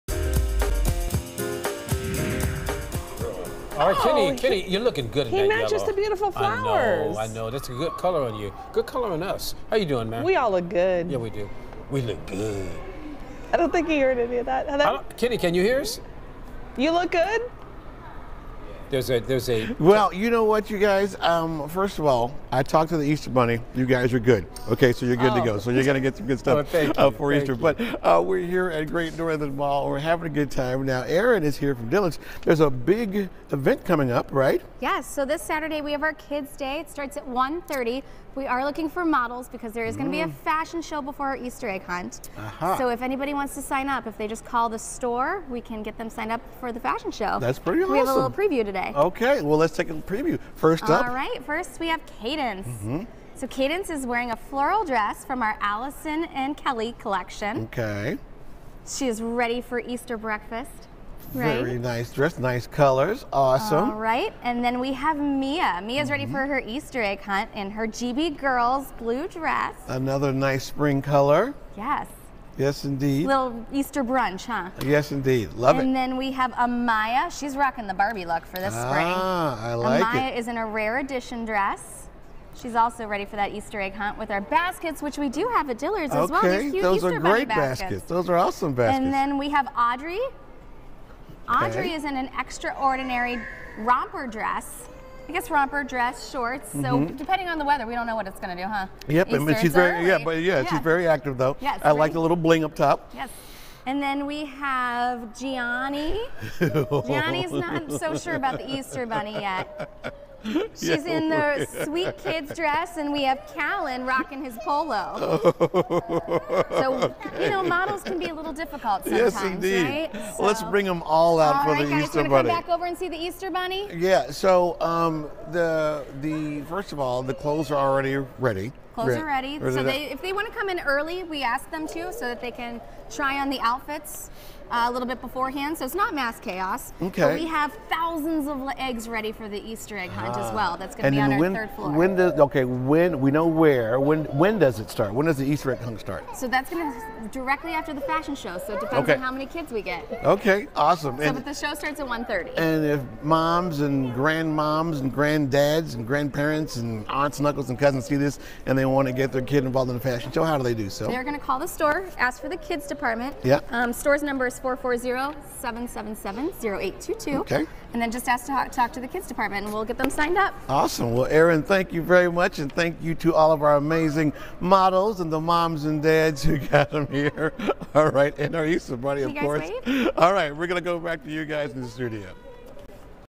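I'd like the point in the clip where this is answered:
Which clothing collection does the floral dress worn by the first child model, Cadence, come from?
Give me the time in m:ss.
0:55.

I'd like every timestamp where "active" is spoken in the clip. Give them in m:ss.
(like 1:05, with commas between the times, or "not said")
1:41.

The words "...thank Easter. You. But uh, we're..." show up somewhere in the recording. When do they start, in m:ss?
0:27.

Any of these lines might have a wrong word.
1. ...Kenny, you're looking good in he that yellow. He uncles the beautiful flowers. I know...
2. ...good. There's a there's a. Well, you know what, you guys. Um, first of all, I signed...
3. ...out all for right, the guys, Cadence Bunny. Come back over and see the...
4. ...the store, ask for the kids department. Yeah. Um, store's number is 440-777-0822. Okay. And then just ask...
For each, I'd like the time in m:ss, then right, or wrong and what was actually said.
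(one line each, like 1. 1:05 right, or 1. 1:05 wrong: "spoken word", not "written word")
1. 0:04 wrong: "matches", not "uncles"
2. 0:17 wrong: "talked", not "signed"
3. 2:01 wrong: "Easter", not "Cadence"
4. 2:41 right.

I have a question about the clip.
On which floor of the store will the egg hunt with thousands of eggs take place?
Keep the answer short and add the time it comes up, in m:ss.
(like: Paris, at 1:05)
Third floor, at 2:21.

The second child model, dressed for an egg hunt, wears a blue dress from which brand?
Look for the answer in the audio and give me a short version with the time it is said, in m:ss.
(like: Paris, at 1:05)
GB Girls, at 1:07.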